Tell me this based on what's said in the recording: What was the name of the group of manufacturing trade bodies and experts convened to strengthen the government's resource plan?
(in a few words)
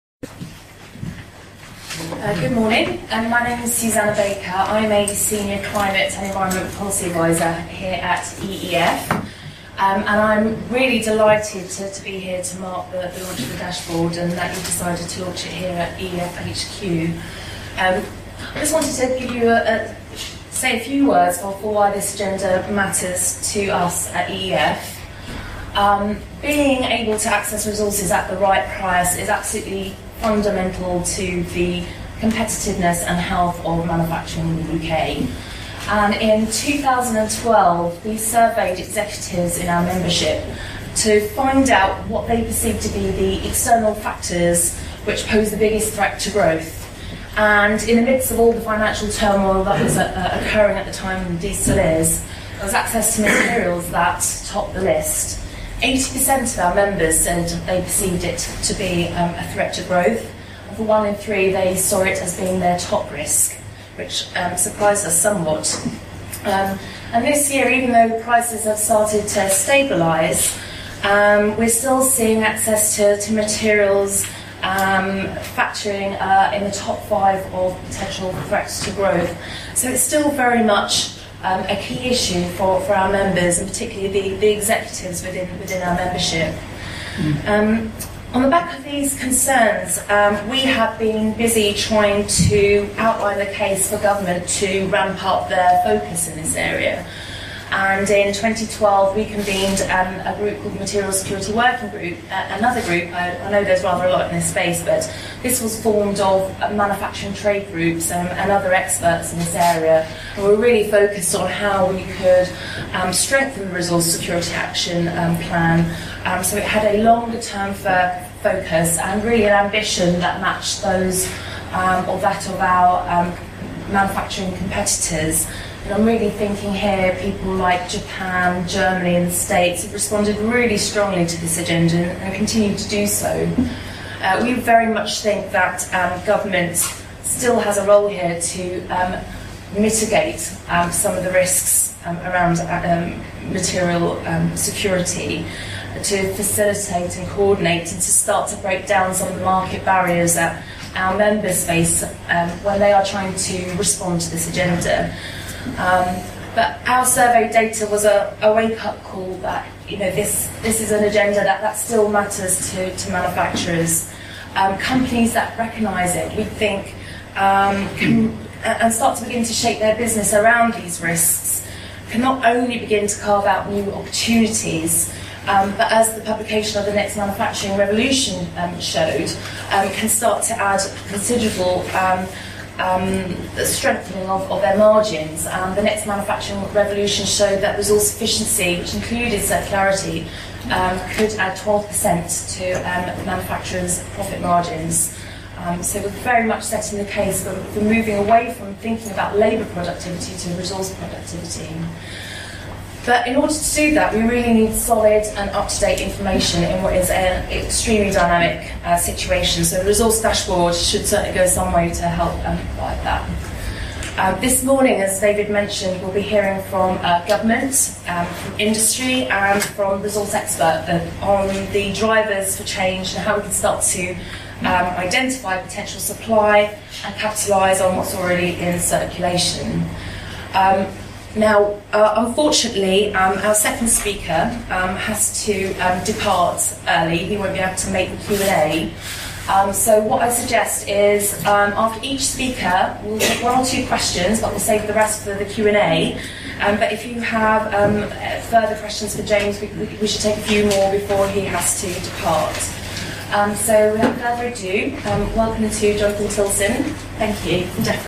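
Material Security Working Group.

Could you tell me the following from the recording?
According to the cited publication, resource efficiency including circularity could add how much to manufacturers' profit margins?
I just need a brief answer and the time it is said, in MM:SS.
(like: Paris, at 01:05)
12%, at 03:11.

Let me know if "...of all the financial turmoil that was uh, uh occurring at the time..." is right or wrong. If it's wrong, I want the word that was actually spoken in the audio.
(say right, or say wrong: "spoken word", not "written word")
right.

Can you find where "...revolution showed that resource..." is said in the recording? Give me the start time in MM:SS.
03:06.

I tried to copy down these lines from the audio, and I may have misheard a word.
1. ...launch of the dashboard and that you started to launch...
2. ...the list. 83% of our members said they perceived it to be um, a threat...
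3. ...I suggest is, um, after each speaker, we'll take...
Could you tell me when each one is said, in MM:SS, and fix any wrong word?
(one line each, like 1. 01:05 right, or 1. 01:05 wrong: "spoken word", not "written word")
1. 00:13 wrong: "decided", not "started"
2. 00:54 wrong: "80", not "83"
3. 04:00 right.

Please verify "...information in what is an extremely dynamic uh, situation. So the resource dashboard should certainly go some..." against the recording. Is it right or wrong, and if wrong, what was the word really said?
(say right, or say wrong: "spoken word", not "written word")
right.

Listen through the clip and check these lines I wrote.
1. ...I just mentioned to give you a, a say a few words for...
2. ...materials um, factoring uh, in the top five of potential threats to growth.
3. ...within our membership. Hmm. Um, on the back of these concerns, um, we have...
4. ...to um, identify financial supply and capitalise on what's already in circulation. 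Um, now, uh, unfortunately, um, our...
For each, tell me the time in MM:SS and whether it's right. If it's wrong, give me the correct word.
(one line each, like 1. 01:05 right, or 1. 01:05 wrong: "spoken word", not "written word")
1. 00:18 wrong: "wanted", not "mentioned"
2. 01:13 right
3. 01:25 right
4. 03:43 wrong: "potential", not "financial".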